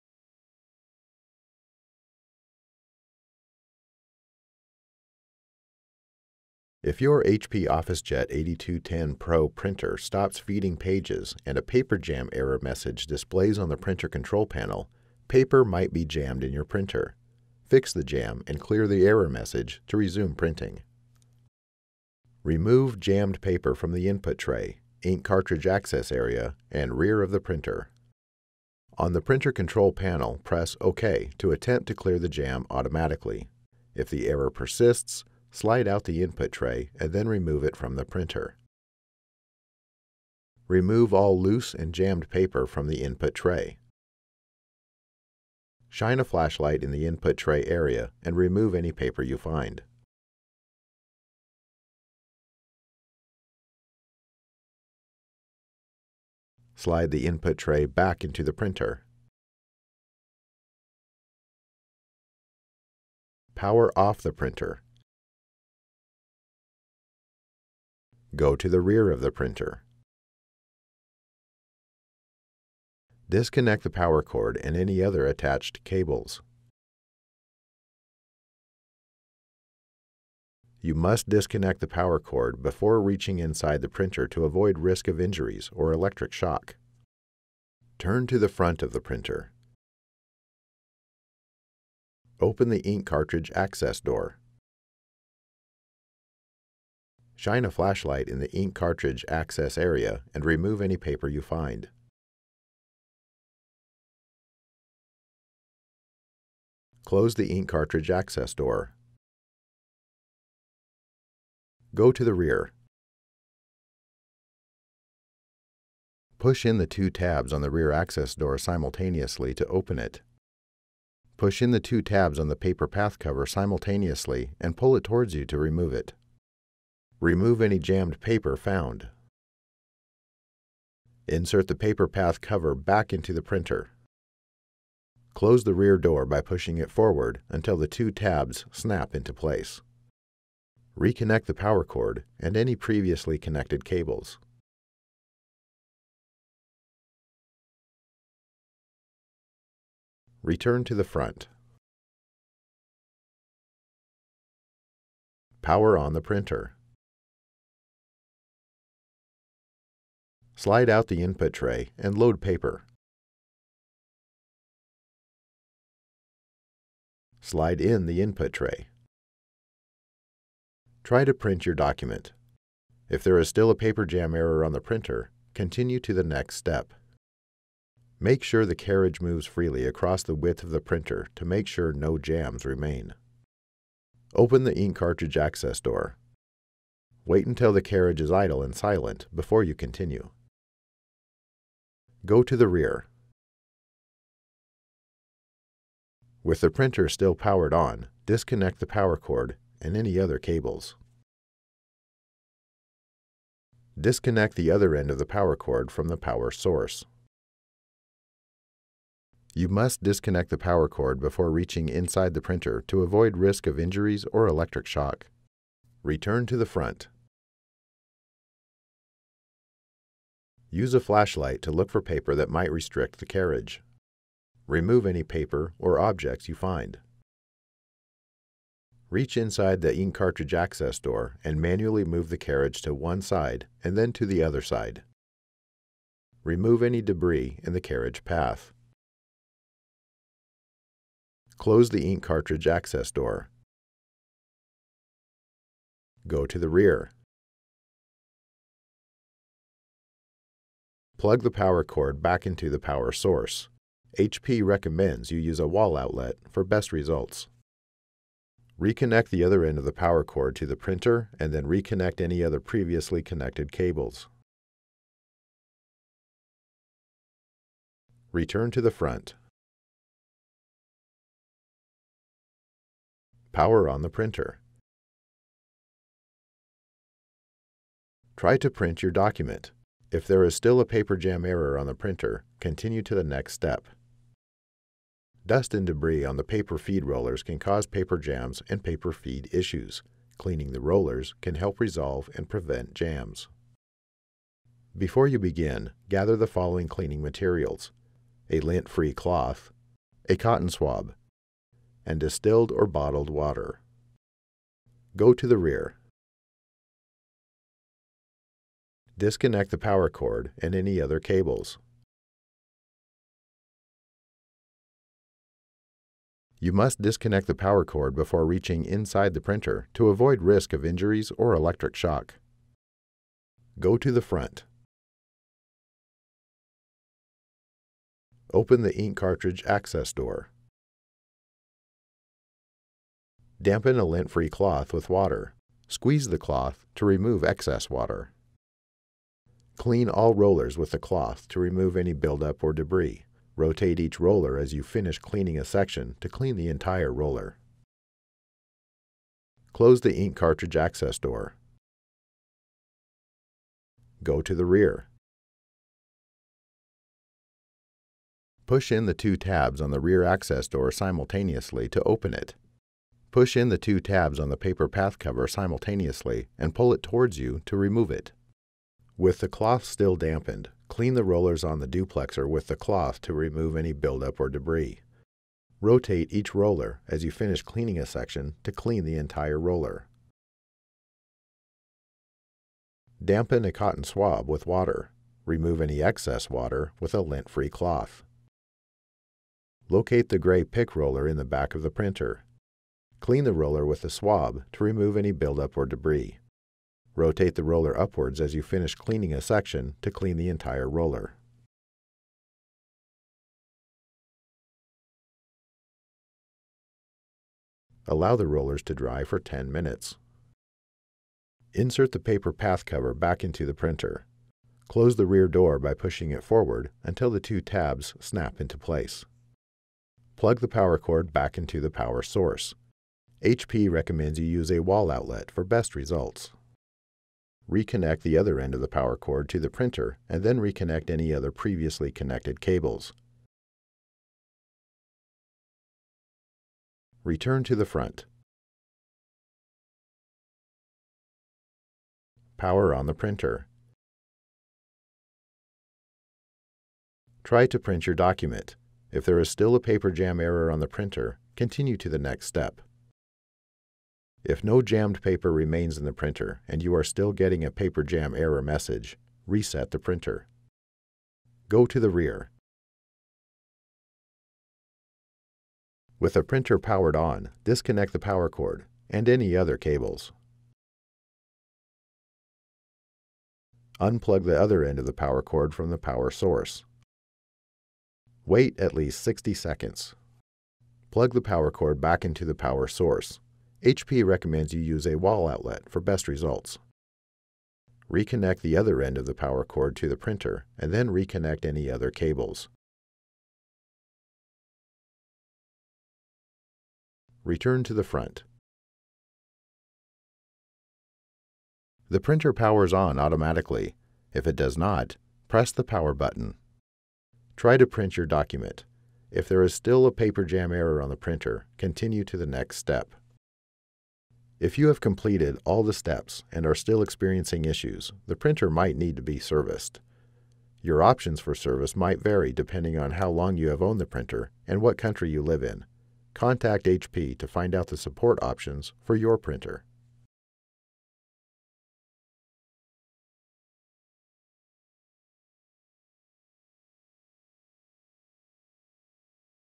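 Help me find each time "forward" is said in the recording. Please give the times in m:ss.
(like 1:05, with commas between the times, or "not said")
2:16, 6:56.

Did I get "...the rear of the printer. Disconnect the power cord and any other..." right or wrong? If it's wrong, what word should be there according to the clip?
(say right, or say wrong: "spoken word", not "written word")
right.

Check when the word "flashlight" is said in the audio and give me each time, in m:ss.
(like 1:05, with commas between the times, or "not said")
0:46, 1:37, 3:41.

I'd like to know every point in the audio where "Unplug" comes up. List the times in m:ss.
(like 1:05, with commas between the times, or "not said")
7:53.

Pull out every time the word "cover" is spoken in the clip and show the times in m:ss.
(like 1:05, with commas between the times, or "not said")
2:03, 2:12, 6:05, 6:52.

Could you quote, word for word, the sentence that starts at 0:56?
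Slide the input tray back into the printer.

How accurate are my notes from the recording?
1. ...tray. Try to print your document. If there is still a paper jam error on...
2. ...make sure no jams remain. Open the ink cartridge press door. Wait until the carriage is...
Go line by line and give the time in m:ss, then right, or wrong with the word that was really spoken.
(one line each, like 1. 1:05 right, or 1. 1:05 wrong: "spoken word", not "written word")
1. 2:48 right
2. 3:01 wrong: "access", not "press".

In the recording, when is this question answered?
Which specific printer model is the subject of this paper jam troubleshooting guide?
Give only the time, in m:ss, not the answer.
0:07.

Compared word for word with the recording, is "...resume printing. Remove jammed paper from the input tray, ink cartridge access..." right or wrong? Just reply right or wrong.
right.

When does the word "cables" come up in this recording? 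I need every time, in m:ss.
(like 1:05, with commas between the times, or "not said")
1:15, 2:23, 3:20, 4:23, 5:11, 7:12, 7:49, 8:12.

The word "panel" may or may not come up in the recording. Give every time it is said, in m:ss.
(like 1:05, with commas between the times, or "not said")
0:14, 0:29.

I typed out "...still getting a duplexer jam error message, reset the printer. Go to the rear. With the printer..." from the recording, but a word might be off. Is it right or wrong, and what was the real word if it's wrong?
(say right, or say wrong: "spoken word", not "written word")
wrong: "paper", not "duplexer".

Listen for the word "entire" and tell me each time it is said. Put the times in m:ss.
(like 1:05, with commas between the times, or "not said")
5:46, 6:19, 6:40.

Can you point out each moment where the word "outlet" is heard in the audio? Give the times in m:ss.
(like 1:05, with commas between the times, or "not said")
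4:15, 7:05, 8:05.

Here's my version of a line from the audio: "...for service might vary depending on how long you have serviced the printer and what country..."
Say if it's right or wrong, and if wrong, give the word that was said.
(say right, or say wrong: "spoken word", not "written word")
wrong: "owned", not "serviced".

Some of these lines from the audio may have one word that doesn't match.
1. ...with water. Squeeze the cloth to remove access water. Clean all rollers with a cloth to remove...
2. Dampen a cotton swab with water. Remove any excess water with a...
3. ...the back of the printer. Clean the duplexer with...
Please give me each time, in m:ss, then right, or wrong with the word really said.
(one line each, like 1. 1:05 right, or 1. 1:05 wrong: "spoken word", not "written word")
1. 5:34 wrong: "excess", not "access"
2. 6:23 right
3. 6:31 wrong: "roller", not "duplexer".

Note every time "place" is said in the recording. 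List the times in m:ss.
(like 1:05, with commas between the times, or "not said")
2:19, 6:58.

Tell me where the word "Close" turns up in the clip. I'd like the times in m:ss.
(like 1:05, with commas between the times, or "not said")
1:47, 2:15, 4:01, 5:49, 6:54.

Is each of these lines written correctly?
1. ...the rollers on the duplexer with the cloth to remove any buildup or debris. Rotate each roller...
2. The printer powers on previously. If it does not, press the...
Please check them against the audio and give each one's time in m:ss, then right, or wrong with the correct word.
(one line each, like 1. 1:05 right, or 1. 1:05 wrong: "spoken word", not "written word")
1. 6:11 right
2. 8:22 wrong: "automatically", not "previously".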